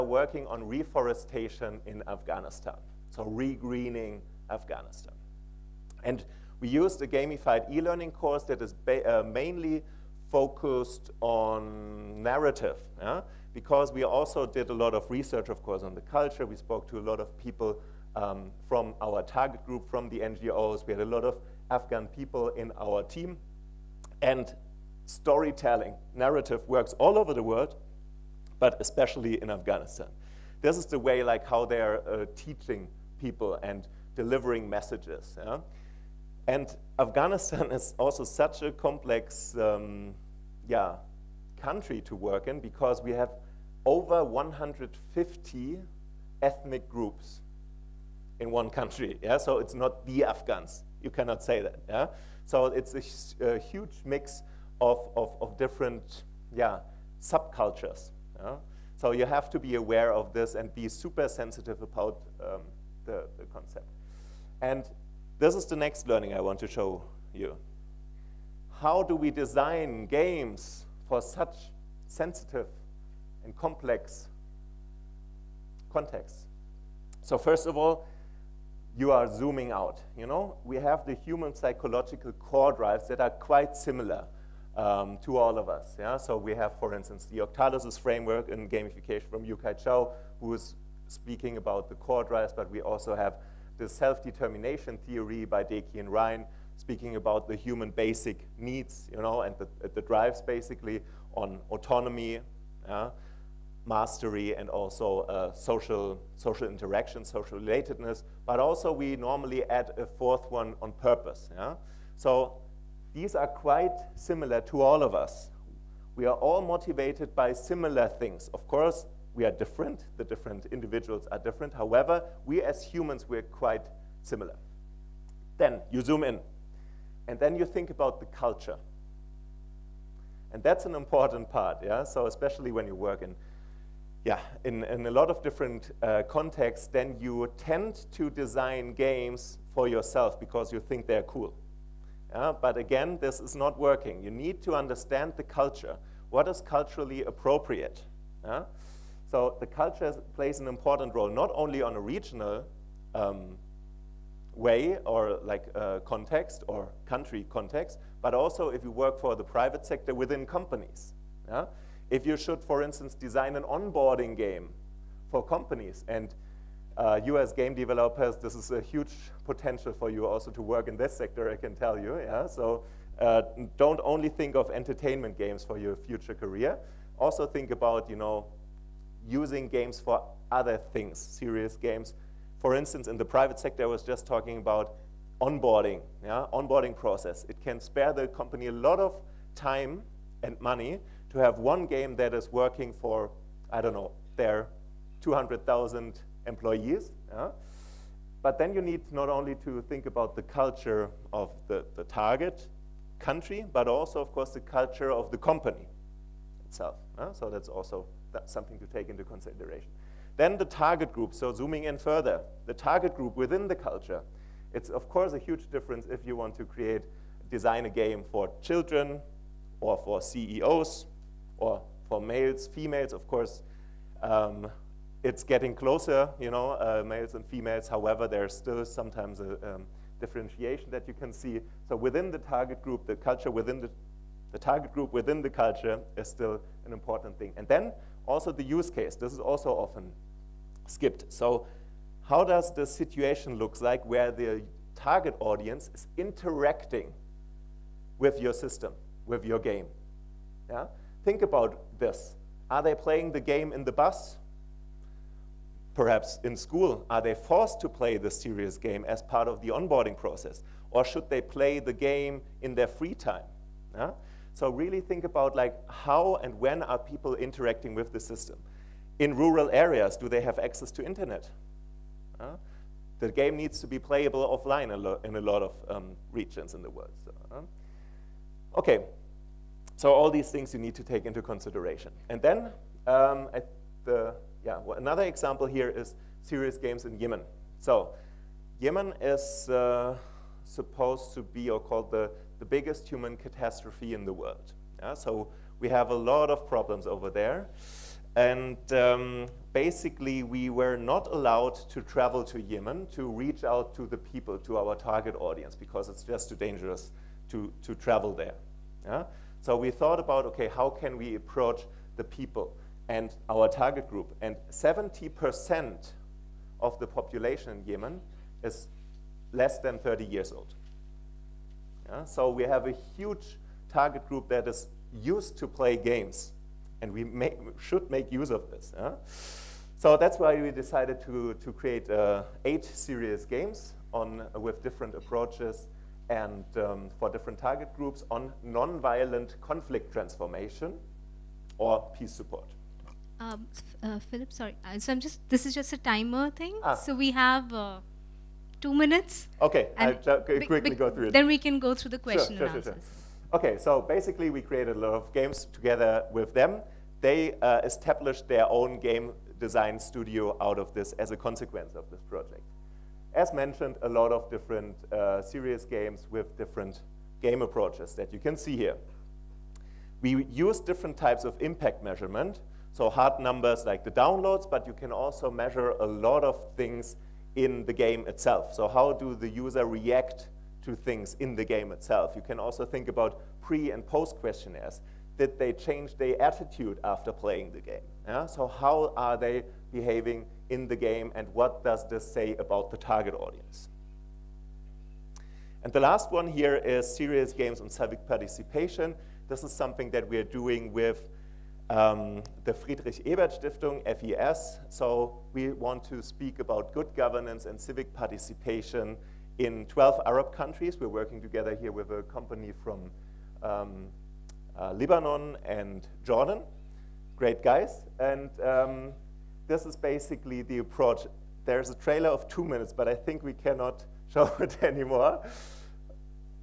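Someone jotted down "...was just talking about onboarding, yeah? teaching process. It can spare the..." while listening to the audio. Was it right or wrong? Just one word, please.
wrong.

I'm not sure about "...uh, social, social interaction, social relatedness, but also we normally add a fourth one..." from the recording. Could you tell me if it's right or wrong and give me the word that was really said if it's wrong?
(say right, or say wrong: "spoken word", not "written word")
right.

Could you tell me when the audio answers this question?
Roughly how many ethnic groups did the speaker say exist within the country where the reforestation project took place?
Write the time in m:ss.
0:43.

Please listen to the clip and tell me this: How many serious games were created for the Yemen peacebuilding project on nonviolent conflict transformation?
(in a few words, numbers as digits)
8.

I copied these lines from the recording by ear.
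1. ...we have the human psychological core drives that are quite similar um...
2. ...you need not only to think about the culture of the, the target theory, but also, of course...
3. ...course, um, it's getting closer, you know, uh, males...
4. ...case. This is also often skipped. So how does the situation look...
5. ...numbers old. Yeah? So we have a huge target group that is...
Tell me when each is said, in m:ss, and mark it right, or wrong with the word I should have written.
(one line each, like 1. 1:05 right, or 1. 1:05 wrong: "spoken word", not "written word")
1. 1:20 right
2. 3:18 wrong: "country", not "theory"
3. 3:43 right
4. 3:58 right
5. 5:20 wrong: "years", not "numbers".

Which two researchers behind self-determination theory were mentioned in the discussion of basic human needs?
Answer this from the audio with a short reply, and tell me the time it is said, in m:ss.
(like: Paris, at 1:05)
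Deci and Ryan, at 1:35.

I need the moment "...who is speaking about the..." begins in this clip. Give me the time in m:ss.
1:30.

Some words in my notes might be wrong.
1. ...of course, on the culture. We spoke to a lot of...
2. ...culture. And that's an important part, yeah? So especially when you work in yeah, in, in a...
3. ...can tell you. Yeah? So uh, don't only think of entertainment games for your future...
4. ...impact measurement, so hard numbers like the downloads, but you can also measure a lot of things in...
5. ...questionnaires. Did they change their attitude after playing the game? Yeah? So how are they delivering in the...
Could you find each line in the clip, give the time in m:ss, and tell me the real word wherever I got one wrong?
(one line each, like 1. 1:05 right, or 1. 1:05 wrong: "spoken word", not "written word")
1. 0:15 right
2. 2:08 right
3. 2:51 right
4. 6:11 right
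5. 6:24 wrong: "behaving", not "delivering".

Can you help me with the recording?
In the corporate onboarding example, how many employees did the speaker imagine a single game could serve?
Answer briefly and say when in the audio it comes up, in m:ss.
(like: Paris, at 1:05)
200,000, at 3:15.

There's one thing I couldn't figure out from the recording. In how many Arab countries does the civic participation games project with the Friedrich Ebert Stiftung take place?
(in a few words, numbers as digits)
12.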